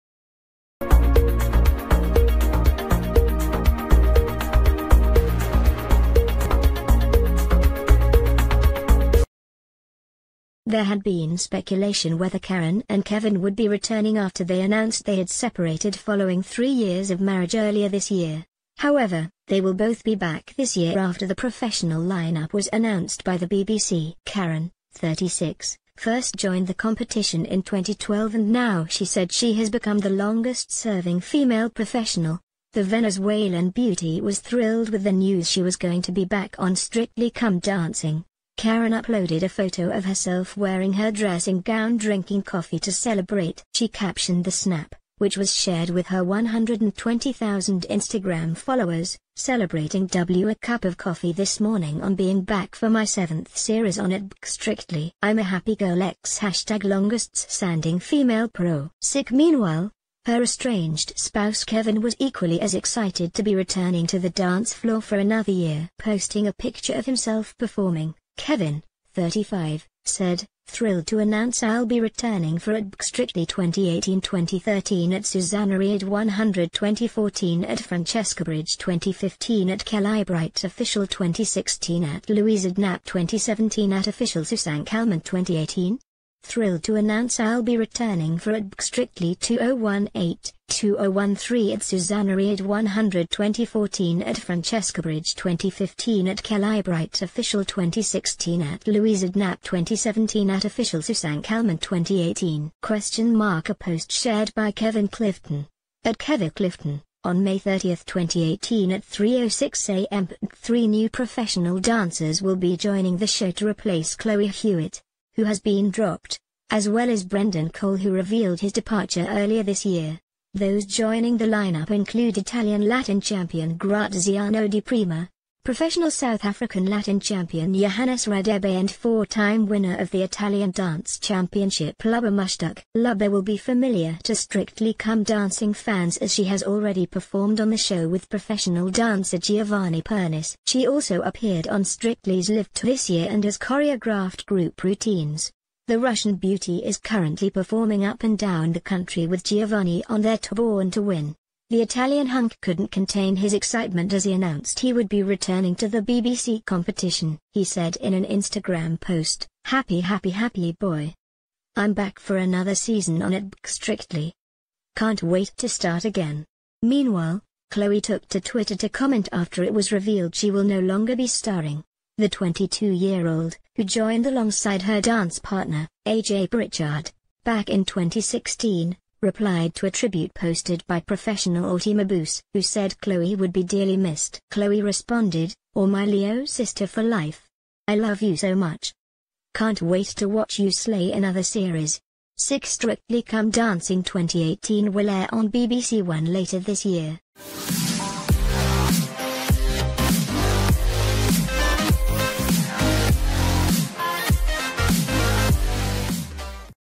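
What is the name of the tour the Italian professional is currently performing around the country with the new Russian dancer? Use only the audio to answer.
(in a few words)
Born to Win.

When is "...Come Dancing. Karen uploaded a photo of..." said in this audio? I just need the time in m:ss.
0:37.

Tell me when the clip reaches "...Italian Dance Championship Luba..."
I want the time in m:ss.
2:10.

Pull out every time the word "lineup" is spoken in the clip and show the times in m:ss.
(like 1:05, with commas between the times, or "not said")
0:22, 2:01.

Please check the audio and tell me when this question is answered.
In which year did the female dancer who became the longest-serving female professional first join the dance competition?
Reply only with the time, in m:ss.
0:27.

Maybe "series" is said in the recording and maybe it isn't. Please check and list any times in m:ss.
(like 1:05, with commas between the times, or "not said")
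0:53, 3:11.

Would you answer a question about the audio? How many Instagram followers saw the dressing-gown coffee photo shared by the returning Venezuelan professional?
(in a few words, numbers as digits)
120,000.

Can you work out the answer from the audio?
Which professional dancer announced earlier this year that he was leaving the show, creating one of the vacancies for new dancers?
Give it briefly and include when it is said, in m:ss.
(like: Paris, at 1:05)
Brendan Cole, at 1:57.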